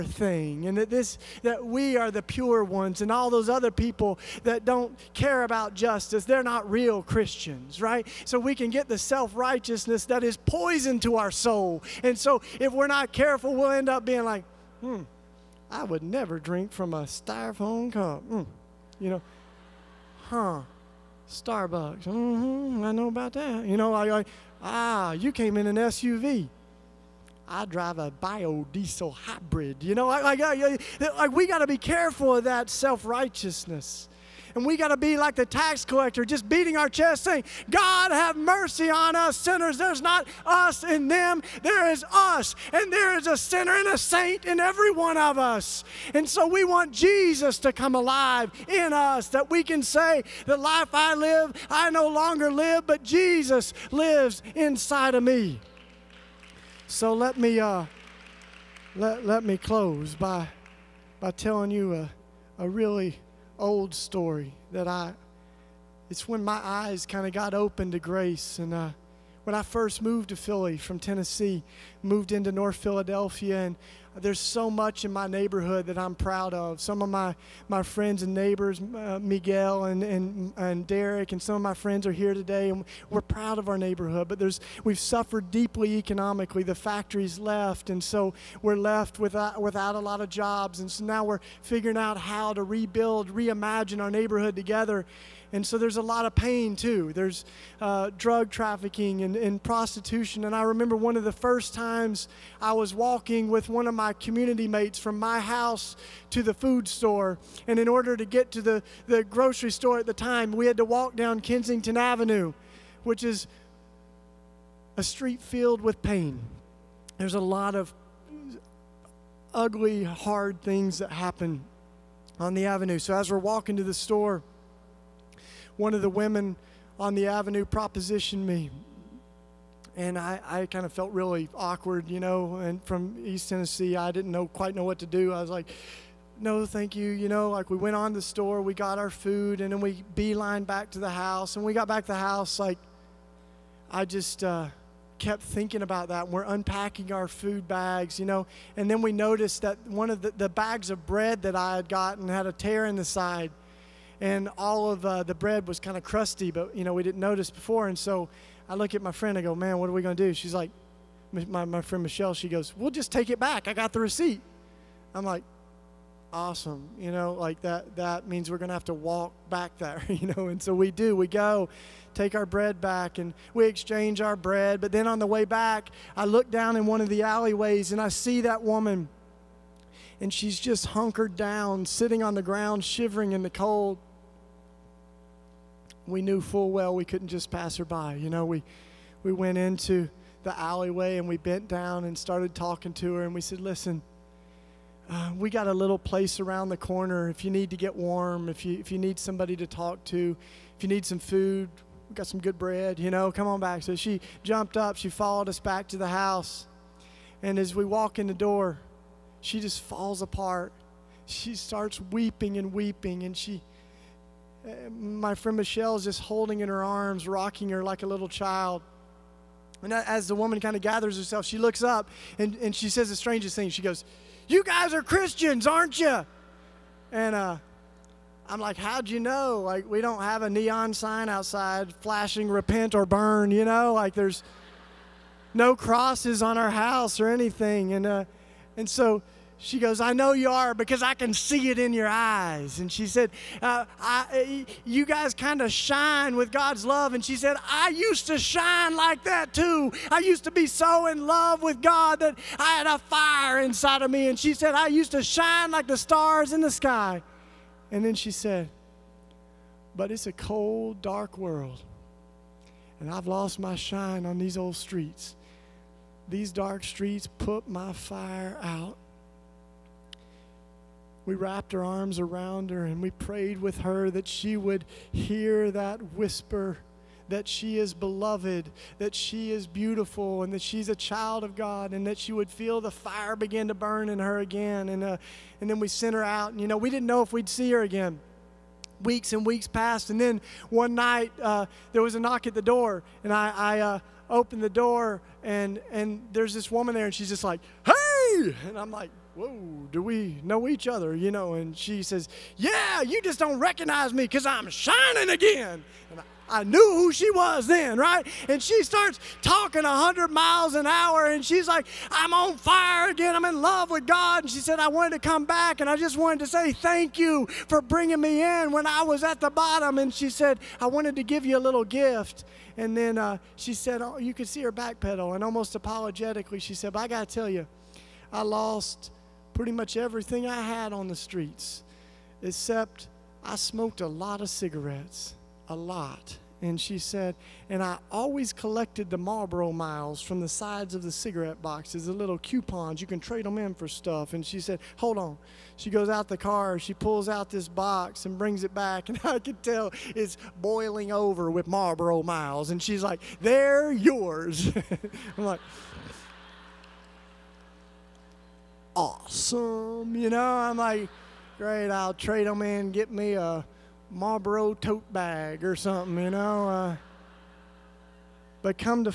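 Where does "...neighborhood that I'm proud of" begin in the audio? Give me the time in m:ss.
1:15.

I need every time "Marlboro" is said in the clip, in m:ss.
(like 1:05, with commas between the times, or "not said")
5:39, 5:51, 6:04.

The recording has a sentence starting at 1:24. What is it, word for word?
But there's, we've suffered deeply economically.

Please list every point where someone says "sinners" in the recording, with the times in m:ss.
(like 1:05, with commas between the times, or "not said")
0:39, 0:43.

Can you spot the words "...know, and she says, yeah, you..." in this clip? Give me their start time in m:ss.
5:01.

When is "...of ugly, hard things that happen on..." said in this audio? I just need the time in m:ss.
1:57.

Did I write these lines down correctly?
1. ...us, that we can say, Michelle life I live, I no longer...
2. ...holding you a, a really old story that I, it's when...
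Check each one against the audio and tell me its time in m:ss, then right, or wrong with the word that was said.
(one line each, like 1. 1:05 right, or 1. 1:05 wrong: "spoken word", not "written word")
1. 0:48 wrong: "The", not "Michelle"
2. 1:01 wrong: "telling", not "holding".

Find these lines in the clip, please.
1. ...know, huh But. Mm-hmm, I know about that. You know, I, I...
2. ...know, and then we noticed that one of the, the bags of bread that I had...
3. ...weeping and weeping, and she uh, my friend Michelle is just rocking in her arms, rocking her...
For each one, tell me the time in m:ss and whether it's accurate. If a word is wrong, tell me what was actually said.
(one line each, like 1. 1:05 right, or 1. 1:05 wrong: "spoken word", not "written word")
1. 0:19 wrong: "Starbucks", not "But"
2. 2:28 right
3. 3:32 wrong: "holding", not "rocking".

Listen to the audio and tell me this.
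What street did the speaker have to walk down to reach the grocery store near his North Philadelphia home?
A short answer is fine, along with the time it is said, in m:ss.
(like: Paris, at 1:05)
Kensington Avenue, at 1:51.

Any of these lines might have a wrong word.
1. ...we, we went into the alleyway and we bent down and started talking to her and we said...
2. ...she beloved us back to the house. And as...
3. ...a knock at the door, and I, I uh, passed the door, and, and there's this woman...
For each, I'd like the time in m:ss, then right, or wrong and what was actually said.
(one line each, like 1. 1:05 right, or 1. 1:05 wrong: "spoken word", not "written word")
1. 3:08 right
2. 3:24 wrong: "followed", not "beloved"
3. 4:52 wrong: "opened", not "passed".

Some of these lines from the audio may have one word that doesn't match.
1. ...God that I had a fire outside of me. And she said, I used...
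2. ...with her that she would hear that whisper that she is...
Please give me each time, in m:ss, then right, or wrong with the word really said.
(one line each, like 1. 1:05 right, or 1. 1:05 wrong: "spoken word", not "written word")
1. 4:11 wrong: "inside", not "outside"
2. 4:33 right.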